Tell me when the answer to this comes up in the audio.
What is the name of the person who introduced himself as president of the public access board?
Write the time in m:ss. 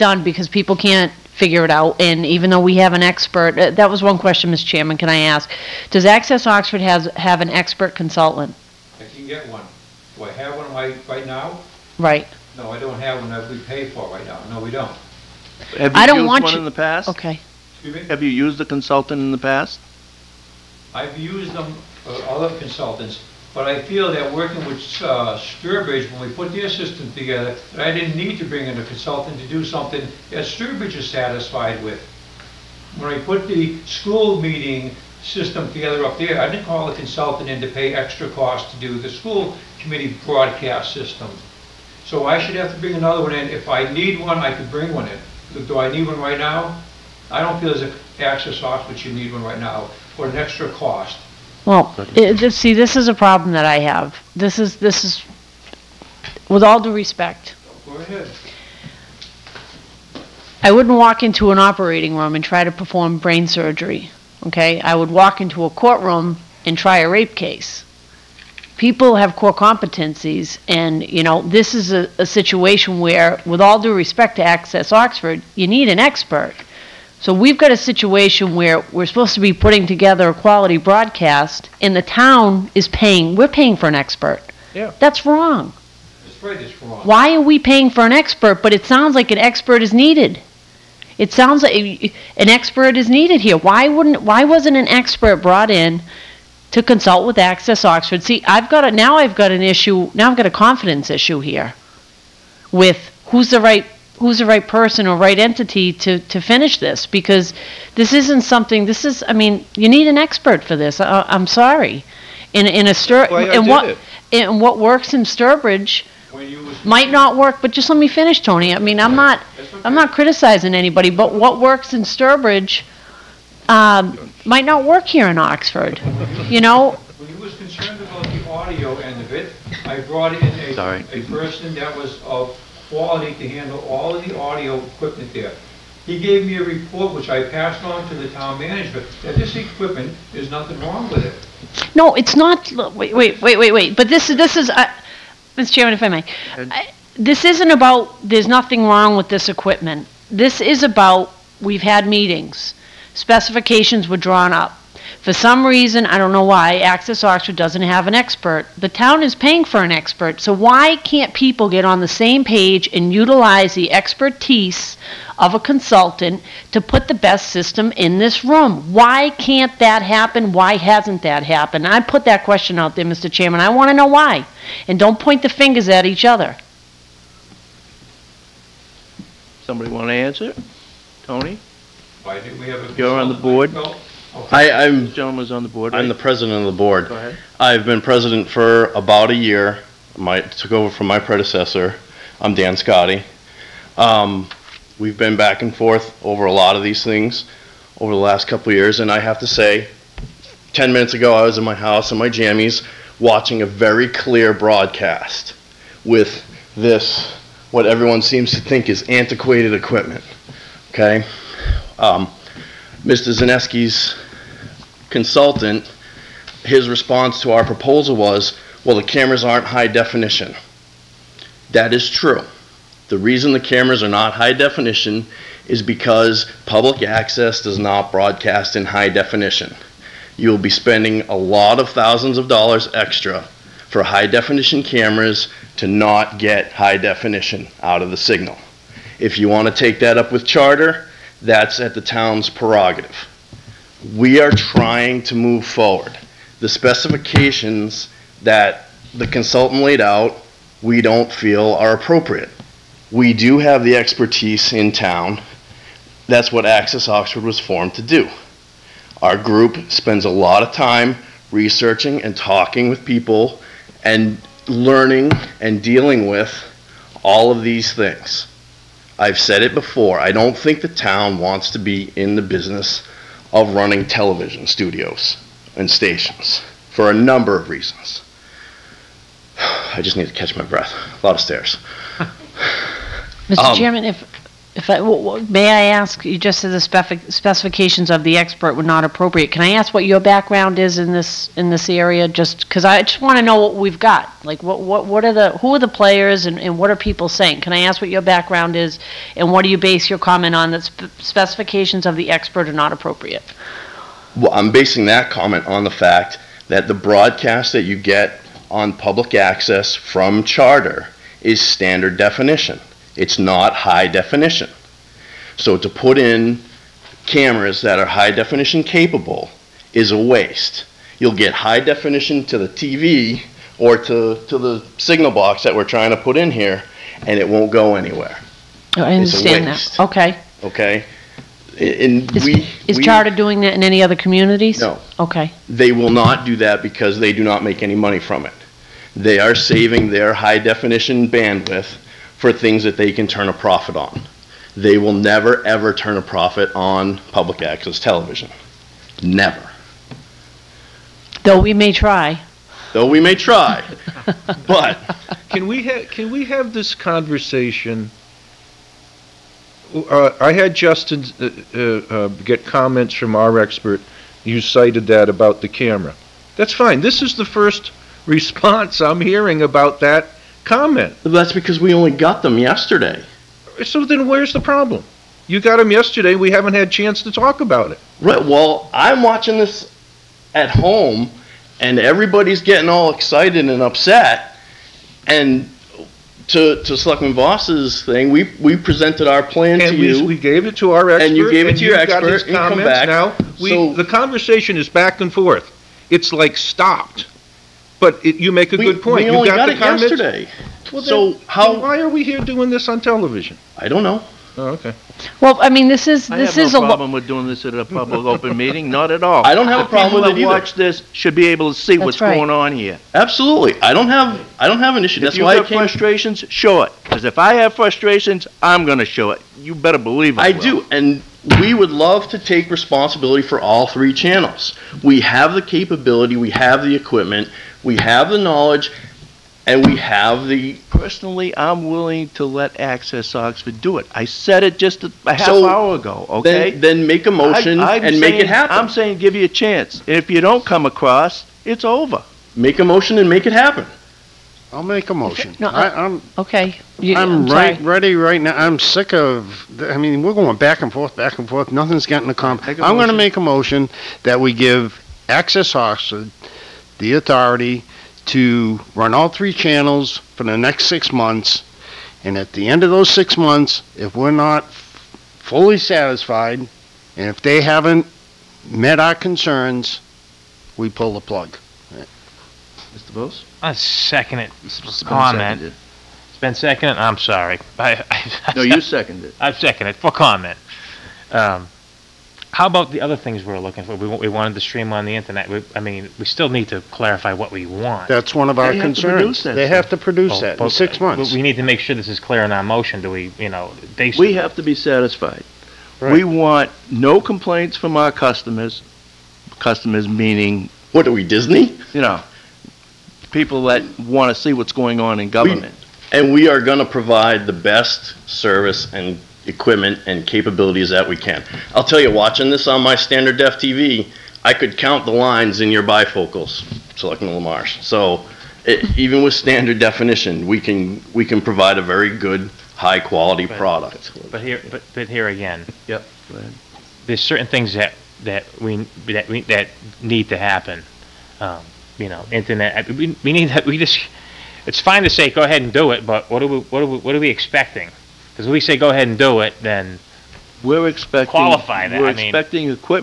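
3:12.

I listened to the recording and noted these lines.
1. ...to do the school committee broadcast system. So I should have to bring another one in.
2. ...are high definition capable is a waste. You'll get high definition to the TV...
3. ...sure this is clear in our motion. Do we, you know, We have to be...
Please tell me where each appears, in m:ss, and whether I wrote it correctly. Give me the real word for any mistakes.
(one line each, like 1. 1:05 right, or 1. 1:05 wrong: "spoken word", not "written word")
1. 0:38 right
2. 5:17 right
3. 8:11 right.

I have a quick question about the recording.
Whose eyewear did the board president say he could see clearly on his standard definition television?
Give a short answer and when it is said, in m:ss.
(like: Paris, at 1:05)
Selectman Lamarche, at 8:36.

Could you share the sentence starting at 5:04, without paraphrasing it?
Well, I'm basing that comment on the fact that the broadcast that you get on public access from Charter is standard definition.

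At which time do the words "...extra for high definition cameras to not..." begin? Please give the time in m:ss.
3:52.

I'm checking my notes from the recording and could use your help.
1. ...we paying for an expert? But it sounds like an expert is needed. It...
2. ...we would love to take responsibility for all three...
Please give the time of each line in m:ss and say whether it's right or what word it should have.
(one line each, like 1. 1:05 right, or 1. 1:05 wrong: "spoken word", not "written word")
1. 1:27 right
2. 7:01 right.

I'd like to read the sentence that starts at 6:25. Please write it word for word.
And to to Selectman Voss's thing, we we presented our plan and to we, you.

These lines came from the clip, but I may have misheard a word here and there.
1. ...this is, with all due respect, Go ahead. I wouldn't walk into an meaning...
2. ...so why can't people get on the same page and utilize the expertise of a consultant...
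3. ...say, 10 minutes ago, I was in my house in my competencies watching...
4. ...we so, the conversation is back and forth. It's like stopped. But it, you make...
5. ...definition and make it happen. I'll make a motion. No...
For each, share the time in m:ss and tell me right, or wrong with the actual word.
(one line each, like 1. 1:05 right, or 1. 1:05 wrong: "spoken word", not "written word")
1. 0:54 wrong: "operating", not "meaning"
2. 2:40 right
3. 3:19 wrong: "jammies", not "competencies"
4. 6:33 right
5. 7:22 wrong: "motion", not "definition".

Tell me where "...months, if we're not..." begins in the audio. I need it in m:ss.
7:43.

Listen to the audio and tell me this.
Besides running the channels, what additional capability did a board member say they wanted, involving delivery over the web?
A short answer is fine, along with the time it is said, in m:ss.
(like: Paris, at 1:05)
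Stream on the internet, at 8:04.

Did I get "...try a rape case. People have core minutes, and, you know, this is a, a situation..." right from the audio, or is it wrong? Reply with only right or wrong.
wrong.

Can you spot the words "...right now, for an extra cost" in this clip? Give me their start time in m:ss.
0:49.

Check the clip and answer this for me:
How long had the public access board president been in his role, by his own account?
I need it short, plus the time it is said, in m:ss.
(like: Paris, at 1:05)
About a year, at 3:08.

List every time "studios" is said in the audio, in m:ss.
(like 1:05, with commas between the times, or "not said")
4:34.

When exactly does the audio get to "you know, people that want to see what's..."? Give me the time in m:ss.
8:21.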